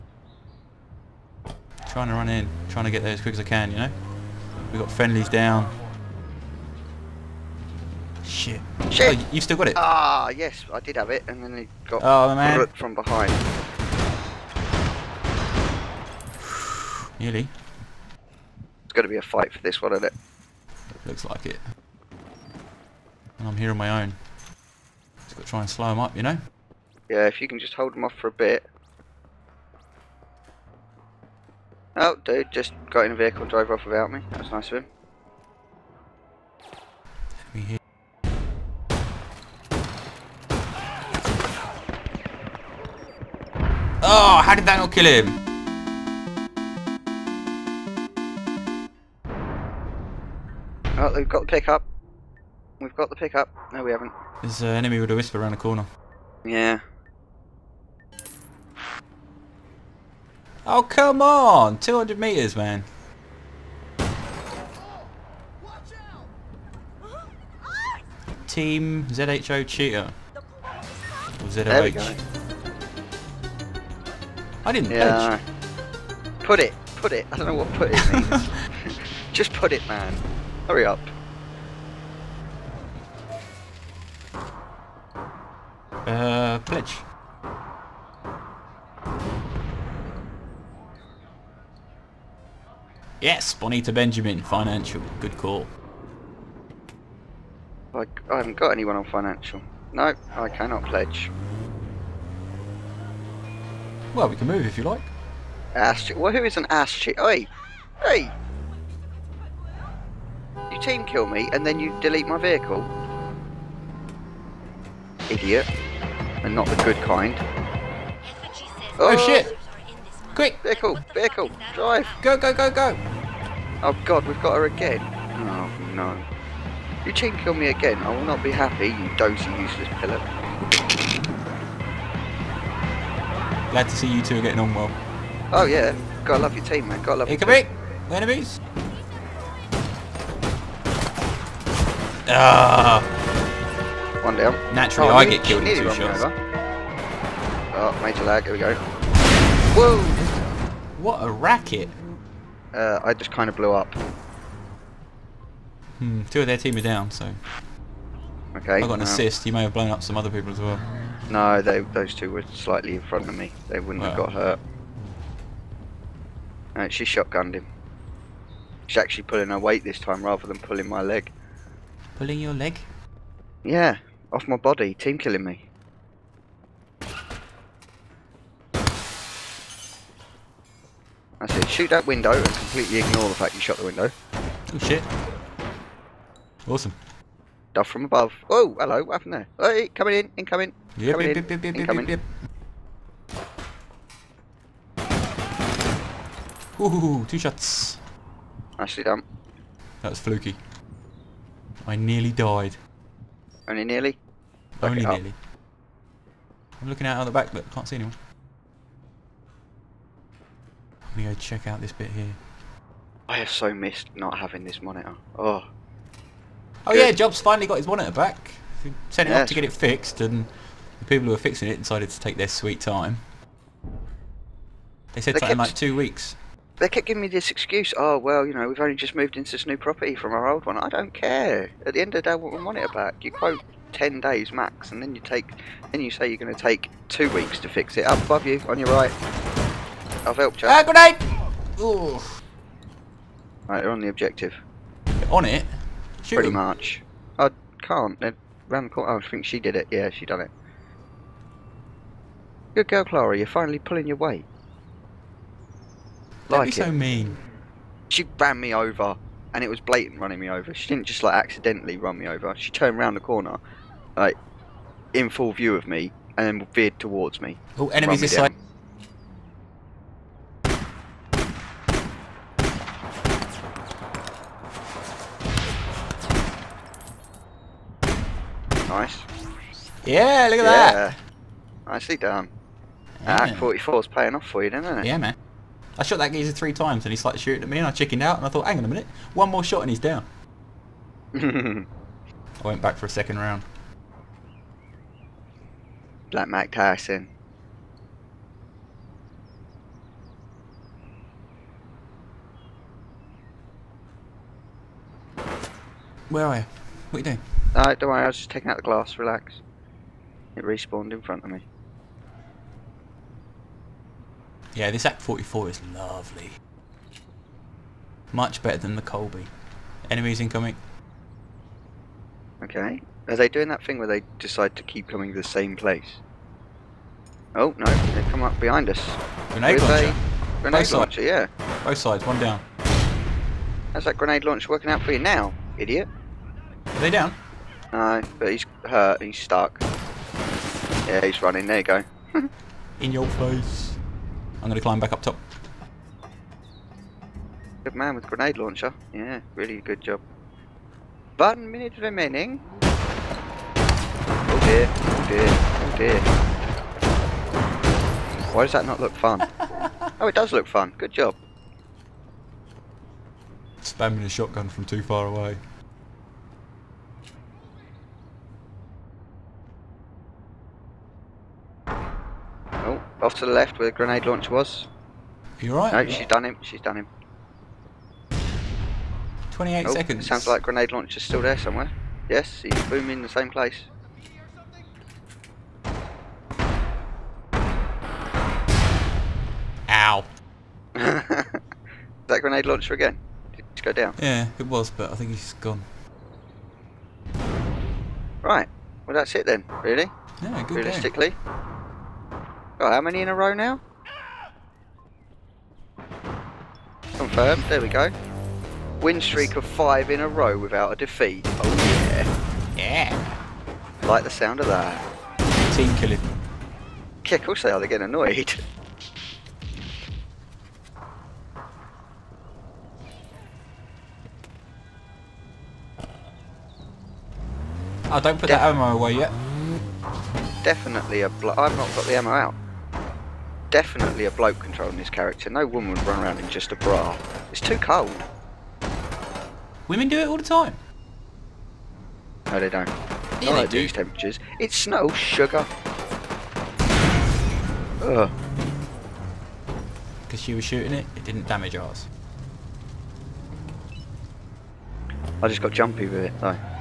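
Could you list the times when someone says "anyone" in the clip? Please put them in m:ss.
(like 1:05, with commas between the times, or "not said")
1:38, 3:27.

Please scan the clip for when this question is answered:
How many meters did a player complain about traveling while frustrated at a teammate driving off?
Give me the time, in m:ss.
1:01.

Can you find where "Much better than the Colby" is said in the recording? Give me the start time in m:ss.
5:18.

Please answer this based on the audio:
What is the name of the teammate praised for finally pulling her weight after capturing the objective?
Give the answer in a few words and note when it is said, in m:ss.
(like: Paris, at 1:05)
Clara, at 4:13.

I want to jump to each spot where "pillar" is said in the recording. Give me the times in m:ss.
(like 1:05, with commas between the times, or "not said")
2:09.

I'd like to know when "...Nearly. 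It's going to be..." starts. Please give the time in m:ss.
0:17.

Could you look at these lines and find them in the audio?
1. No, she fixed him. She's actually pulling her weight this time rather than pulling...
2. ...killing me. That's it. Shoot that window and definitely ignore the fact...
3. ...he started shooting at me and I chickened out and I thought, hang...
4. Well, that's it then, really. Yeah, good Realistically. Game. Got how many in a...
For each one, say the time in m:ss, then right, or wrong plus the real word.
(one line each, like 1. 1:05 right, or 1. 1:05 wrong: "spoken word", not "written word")
1. 2:46 wrong: "shotgunned", not "fixed"
2. 2:55 wrong: "completely", not "definitely"
3. 4:47 right
4. 6:39 right.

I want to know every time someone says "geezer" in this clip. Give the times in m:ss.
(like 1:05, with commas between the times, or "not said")
4:46.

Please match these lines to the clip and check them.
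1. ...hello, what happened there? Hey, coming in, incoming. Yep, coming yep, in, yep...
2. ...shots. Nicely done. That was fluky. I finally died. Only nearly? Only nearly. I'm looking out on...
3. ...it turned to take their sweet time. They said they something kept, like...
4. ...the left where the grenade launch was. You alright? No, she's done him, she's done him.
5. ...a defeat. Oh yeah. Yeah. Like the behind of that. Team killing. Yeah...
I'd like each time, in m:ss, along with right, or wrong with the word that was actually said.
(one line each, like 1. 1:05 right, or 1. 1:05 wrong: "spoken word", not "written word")
1. 3:08 right
2. 3:17 wrong: "nearly", not "finally"
3. 3:41 wrong: "decided", not "turned"
4. 6:13 right
5. 6:50 wrong: "sound", not "behind".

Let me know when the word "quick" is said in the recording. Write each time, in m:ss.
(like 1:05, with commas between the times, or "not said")
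0:03, 2:00.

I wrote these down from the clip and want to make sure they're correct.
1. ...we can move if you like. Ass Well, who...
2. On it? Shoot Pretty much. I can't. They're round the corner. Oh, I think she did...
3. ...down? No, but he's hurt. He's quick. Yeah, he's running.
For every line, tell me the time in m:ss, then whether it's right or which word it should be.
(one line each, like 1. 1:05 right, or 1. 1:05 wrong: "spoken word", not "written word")
1. 1:44 right
2. 4:05 right
3. 5:37 wrong: "stuck", not "quick".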